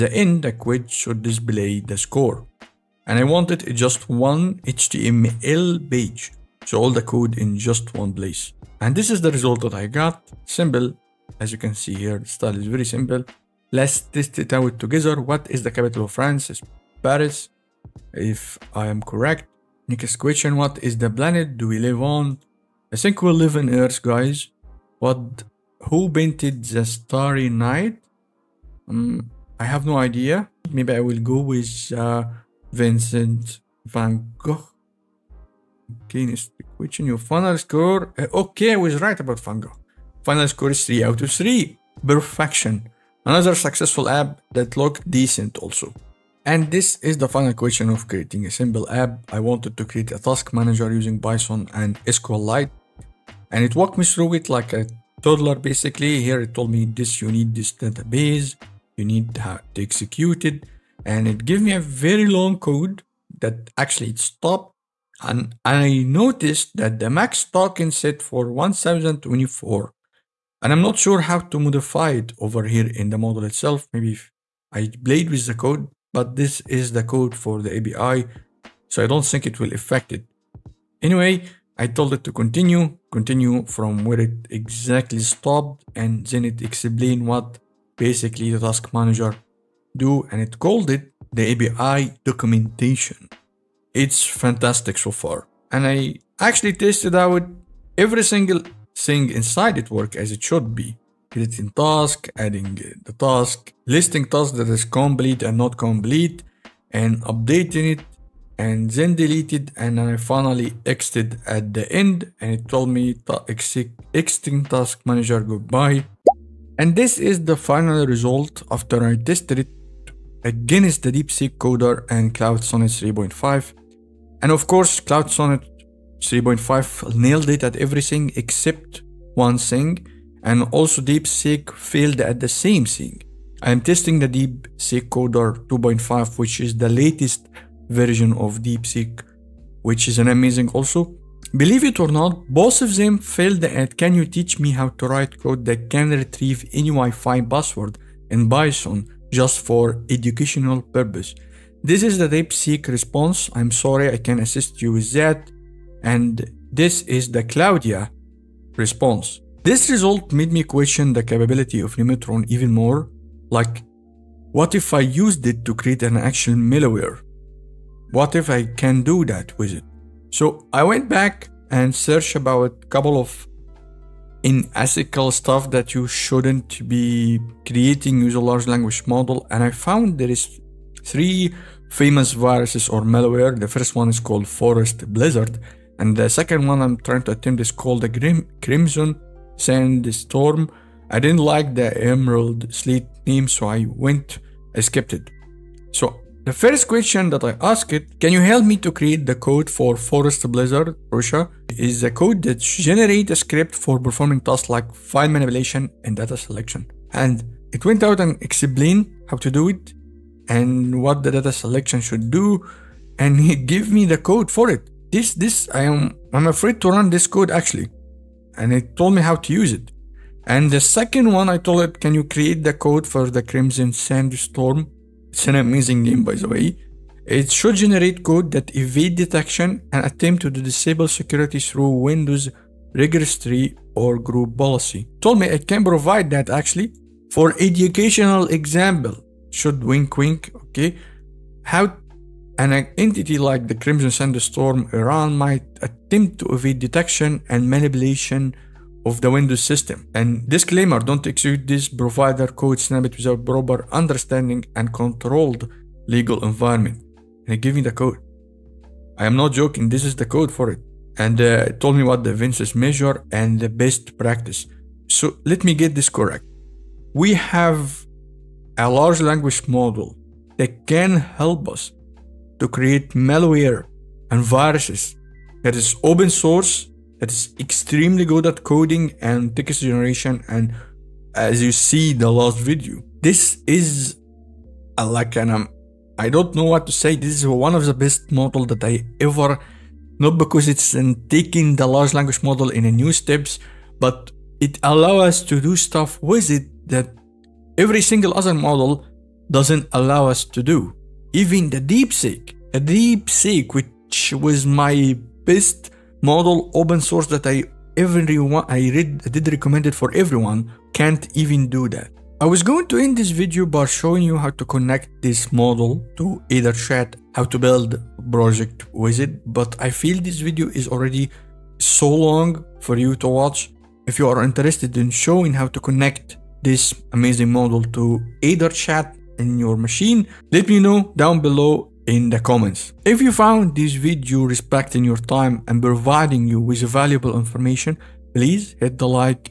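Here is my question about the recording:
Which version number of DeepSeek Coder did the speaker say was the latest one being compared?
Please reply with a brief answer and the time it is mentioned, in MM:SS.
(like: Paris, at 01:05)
2.5, at 02:15.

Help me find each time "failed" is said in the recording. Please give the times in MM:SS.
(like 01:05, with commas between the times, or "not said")
02:11, 02:23.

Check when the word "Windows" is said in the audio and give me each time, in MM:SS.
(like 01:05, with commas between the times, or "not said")
03:52, 04:09.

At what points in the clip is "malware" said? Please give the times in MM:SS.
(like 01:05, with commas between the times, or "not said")
02:46, 03:03, 04:33.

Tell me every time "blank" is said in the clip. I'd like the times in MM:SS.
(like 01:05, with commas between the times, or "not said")
not said.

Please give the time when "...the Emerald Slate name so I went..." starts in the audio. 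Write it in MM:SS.
03:11.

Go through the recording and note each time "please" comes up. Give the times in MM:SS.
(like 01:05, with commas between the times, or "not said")
05:38.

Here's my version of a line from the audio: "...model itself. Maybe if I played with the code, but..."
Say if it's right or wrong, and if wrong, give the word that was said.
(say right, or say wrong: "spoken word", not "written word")
right.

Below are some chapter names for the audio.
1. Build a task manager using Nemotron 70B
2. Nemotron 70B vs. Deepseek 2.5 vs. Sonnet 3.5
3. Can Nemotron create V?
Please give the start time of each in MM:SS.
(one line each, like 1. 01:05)
1. 00:45
2. 01:57
3. 02:21.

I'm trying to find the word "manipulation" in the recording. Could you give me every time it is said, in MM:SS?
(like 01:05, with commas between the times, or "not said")
03:25, 04:07.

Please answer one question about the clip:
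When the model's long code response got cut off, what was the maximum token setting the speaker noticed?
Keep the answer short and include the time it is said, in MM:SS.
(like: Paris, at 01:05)
1024, at 01:08.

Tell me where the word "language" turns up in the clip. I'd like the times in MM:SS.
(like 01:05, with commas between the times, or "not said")
02:58, 04:29, 04:52.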